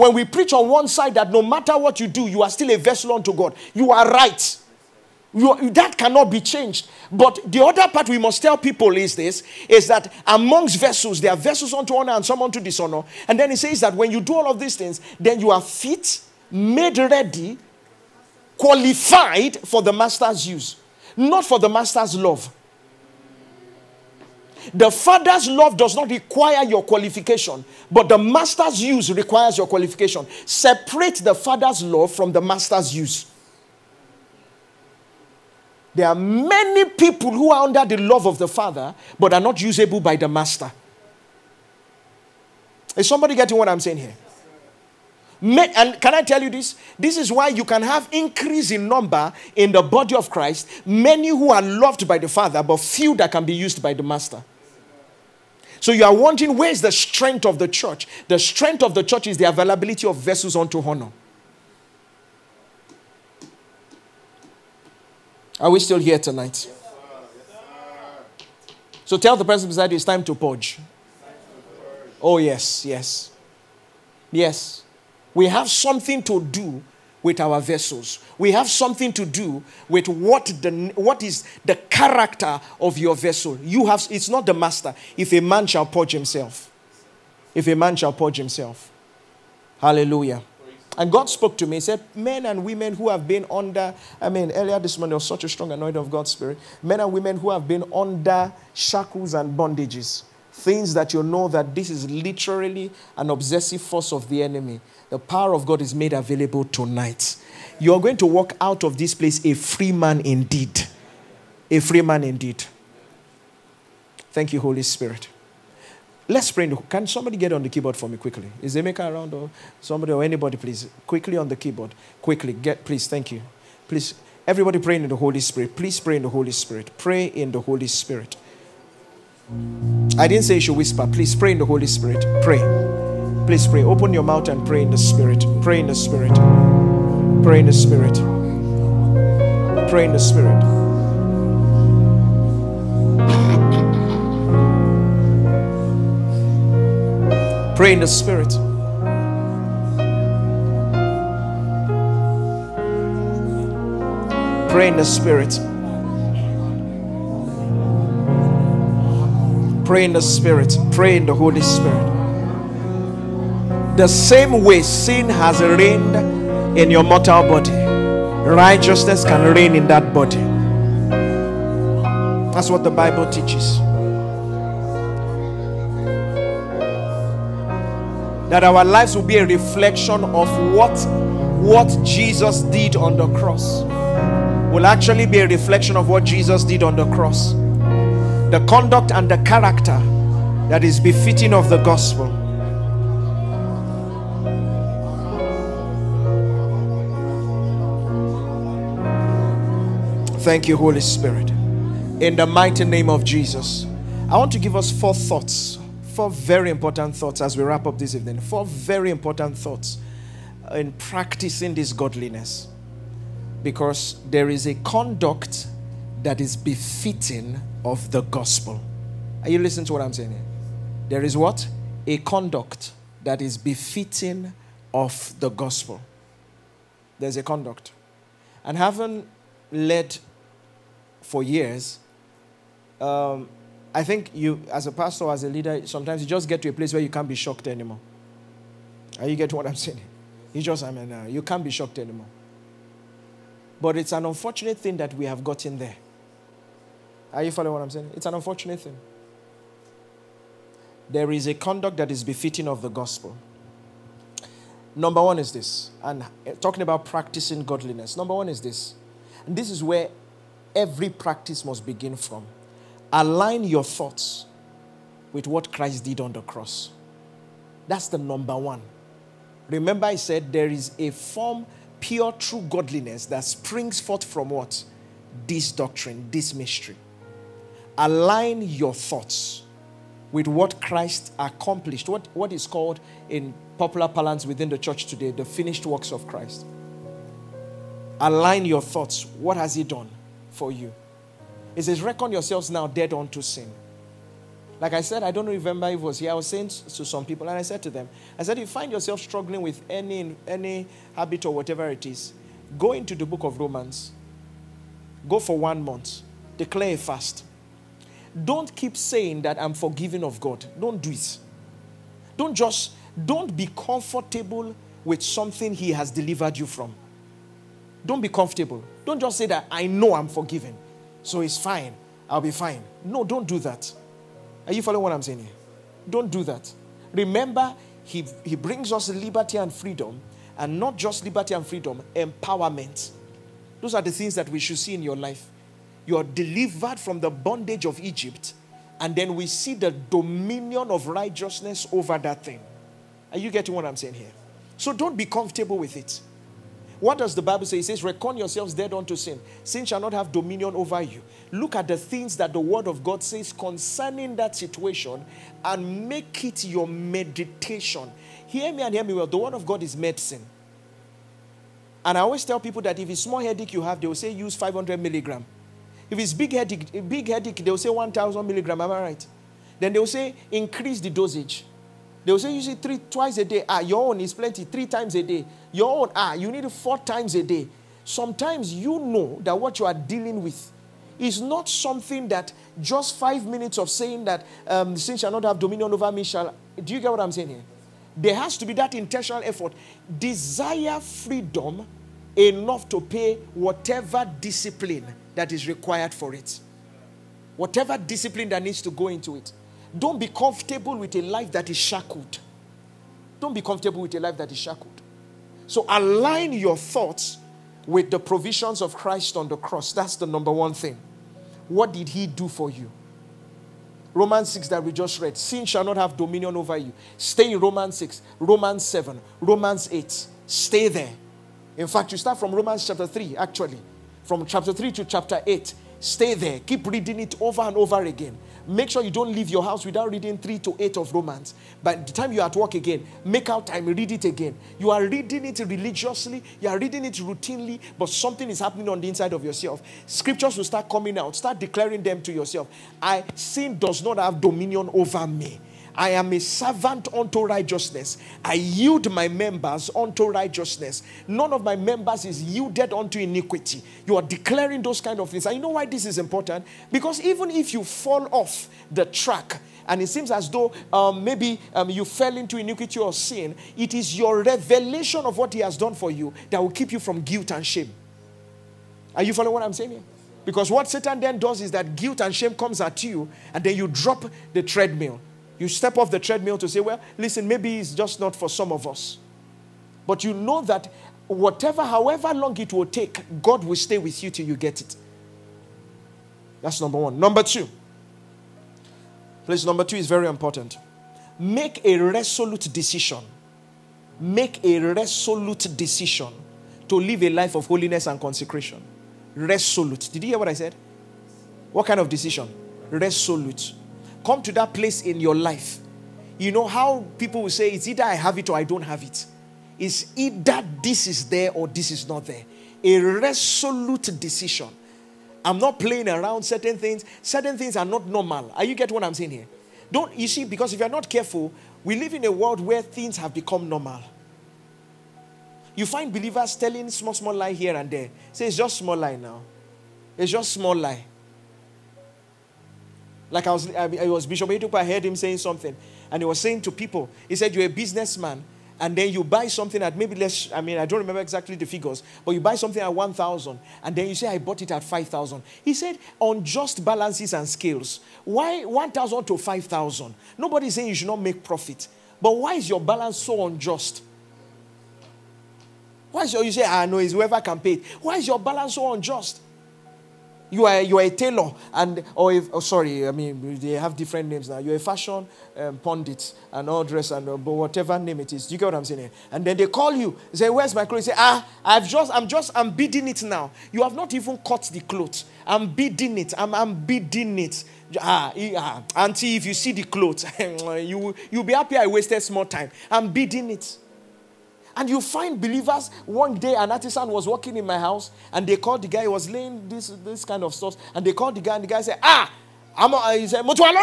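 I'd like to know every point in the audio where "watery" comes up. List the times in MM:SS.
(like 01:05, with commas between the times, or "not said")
not said.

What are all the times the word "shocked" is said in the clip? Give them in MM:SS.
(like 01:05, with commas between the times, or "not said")
03:57, 04:01.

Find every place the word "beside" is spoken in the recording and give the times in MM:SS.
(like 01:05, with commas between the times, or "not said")
01:09.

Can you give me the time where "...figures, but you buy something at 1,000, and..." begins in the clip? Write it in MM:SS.
09:01.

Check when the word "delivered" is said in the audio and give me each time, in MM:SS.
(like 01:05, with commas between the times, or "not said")
05:16, 05:36.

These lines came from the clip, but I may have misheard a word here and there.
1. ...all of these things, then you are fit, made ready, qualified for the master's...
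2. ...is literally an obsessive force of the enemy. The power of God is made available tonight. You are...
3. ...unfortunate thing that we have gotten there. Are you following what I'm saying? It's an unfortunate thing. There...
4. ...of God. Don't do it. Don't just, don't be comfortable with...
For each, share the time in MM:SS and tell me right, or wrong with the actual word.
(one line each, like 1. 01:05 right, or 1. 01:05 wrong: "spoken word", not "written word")
1. 00:14 right
2. 01:41 right
3. 04:04 right
4. 05:10 right.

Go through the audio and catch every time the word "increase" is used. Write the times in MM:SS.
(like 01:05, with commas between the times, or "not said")
00:48, 06:10.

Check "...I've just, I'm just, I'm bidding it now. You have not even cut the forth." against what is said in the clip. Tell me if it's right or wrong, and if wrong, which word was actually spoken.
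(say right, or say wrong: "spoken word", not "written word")
wrong: "cloth", not "forth".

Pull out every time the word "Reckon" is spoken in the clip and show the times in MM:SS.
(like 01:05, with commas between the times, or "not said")
04:52, 05:48.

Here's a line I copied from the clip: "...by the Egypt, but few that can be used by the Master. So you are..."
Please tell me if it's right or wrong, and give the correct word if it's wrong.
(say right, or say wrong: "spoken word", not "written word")
wrong: "Father", not "Egypt".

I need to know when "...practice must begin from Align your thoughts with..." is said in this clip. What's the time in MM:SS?
04:21.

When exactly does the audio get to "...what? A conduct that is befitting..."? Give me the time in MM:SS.
03:41.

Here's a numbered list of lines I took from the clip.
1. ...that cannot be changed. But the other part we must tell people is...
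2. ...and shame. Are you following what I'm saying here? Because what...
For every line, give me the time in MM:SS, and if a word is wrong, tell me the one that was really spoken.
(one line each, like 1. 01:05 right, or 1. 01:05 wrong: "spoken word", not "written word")
1. 00:05 right
2. 07:47 right.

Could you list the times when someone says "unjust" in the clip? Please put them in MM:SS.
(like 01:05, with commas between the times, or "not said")
09:13, 09:18.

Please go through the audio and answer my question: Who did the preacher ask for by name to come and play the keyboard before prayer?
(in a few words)
Emeka.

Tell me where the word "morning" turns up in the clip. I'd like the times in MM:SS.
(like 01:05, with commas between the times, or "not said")
01:34.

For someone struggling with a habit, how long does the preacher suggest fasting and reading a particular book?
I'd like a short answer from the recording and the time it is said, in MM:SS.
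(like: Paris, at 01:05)
One month, at 05:05.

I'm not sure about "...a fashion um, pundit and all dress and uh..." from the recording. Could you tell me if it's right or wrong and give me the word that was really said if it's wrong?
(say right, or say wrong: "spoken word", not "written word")
right.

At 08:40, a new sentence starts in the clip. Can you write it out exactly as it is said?
Because if you're not careful, we live in a world where things have become normal.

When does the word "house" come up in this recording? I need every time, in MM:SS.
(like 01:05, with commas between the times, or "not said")
07:09, 09:47.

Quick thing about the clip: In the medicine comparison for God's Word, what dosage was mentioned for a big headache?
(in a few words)
1,000 milligram.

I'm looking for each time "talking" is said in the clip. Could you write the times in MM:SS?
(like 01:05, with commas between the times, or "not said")
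04:16.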